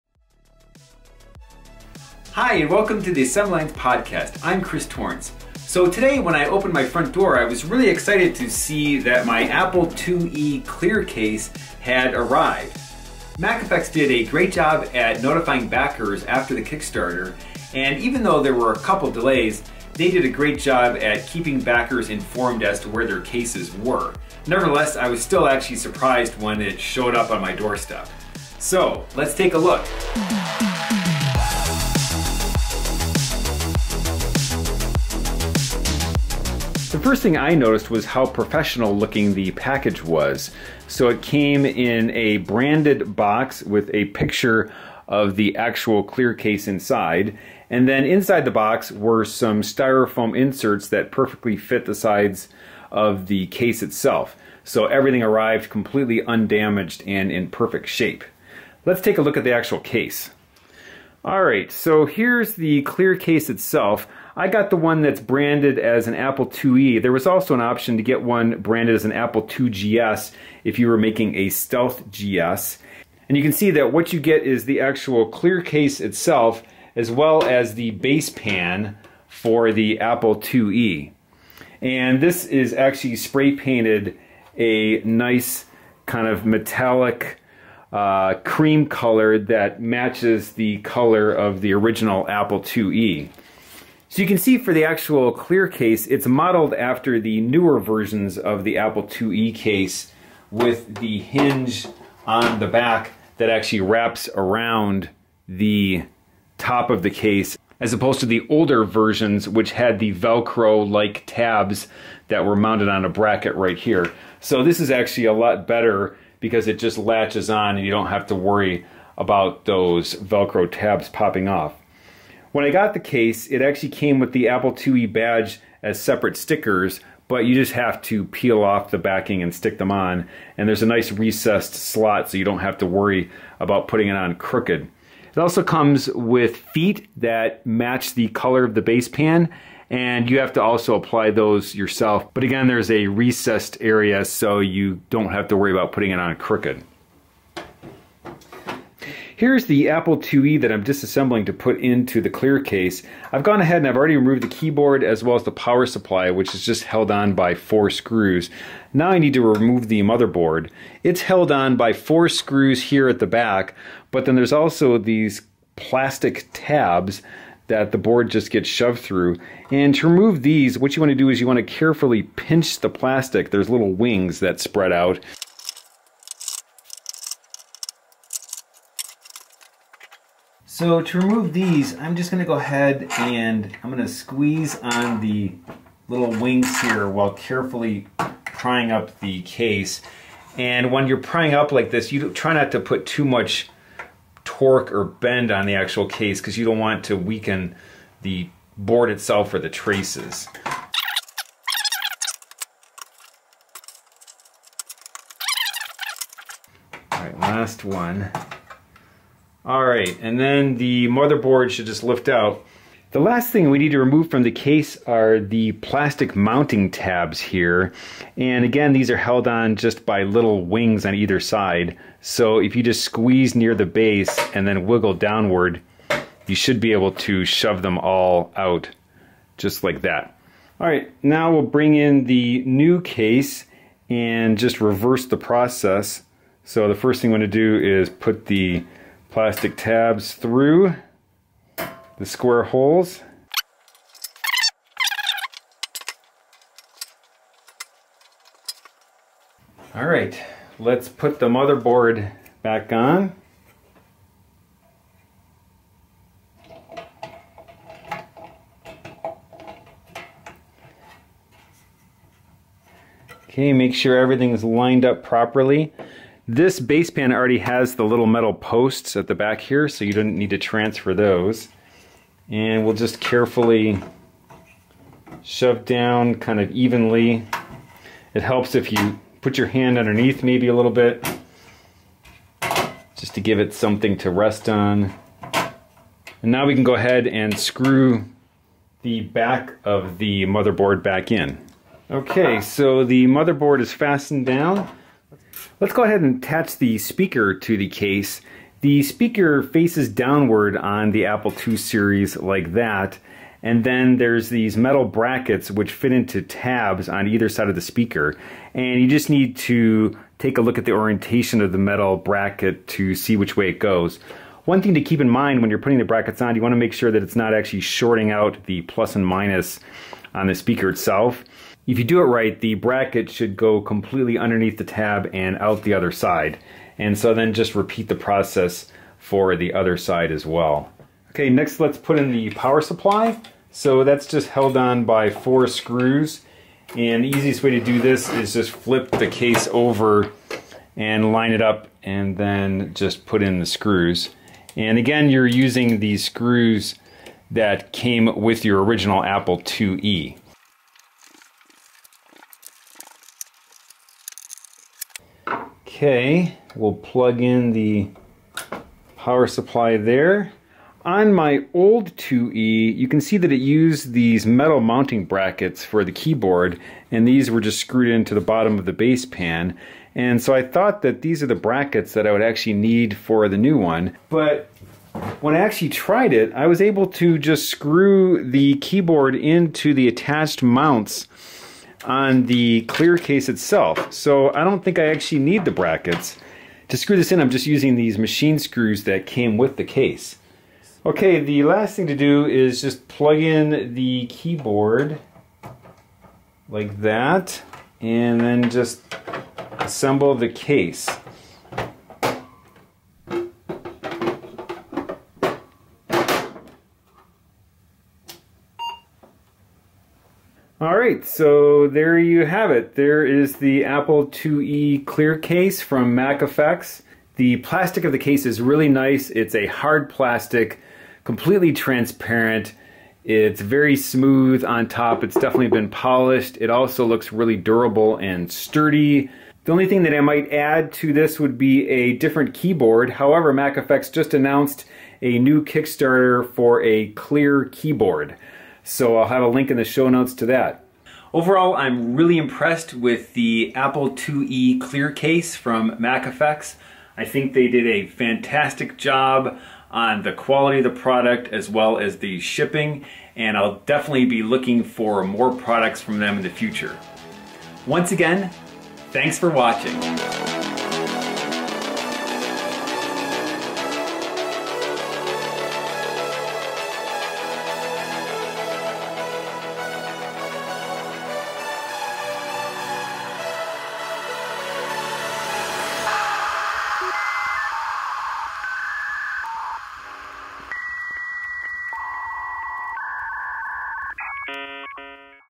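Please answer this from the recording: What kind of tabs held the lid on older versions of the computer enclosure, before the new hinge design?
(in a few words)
Velcro-like tabs.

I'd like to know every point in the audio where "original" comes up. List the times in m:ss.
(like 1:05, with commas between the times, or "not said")
1:31, 5:48.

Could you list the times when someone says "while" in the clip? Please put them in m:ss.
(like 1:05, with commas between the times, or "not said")
3:07.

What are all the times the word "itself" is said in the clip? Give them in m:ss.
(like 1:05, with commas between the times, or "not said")
0:53, 1:03, 1:15, 3:19, 5:20, 6:23.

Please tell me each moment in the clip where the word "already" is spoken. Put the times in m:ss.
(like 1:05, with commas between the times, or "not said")
2:33, 4:27.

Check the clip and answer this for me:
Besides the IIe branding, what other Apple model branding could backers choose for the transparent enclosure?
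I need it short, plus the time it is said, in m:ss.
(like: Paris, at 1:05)
Apple IIgs, at 1:09.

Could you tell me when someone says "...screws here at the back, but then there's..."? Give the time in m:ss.
2:42.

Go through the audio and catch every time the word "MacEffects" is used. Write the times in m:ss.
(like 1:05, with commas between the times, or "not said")
0:13, 6:56, 7:13, 7:25.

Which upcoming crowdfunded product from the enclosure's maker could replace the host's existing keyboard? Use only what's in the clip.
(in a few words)
clear keyboard.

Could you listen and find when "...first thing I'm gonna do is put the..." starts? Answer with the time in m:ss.
3:56.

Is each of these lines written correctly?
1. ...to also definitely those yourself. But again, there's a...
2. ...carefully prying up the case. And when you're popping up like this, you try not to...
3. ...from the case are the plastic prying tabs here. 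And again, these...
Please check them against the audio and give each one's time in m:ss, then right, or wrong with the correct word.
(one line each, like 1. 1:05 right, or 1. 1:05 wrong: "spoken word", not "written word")
1. 2:20 wrong: "apply", not "definitely"
2. 3:07 wrong: "prying", not "popping"
3. 3:34 wrong: "mounting", not "prying".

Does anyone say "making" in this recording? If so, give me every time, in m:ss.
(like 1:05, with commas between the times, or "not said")
1:10.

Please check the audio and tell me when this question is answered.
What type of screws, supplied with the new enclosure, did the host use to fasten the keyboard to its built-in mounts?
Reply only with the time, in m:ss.
6:28.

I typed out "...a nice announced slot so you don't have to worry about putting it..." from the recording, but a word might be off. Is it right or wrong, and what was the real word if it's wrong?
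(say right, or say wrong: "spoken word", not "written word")
wrong: "recessed", not "announced".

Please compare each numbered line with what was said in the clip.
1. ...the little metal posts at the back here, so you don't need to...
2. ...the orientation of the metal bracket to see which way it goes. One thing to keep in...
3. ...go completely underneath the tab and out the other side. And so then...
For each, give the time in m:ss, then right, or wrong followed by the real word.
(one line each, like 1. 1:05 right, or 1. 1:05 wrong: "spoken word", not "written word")
1. 4:27 right
2. 5:10 right
3. 5:23 right.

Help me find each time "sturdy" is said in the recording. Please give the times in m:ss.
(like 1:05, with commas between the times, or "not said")
7:08.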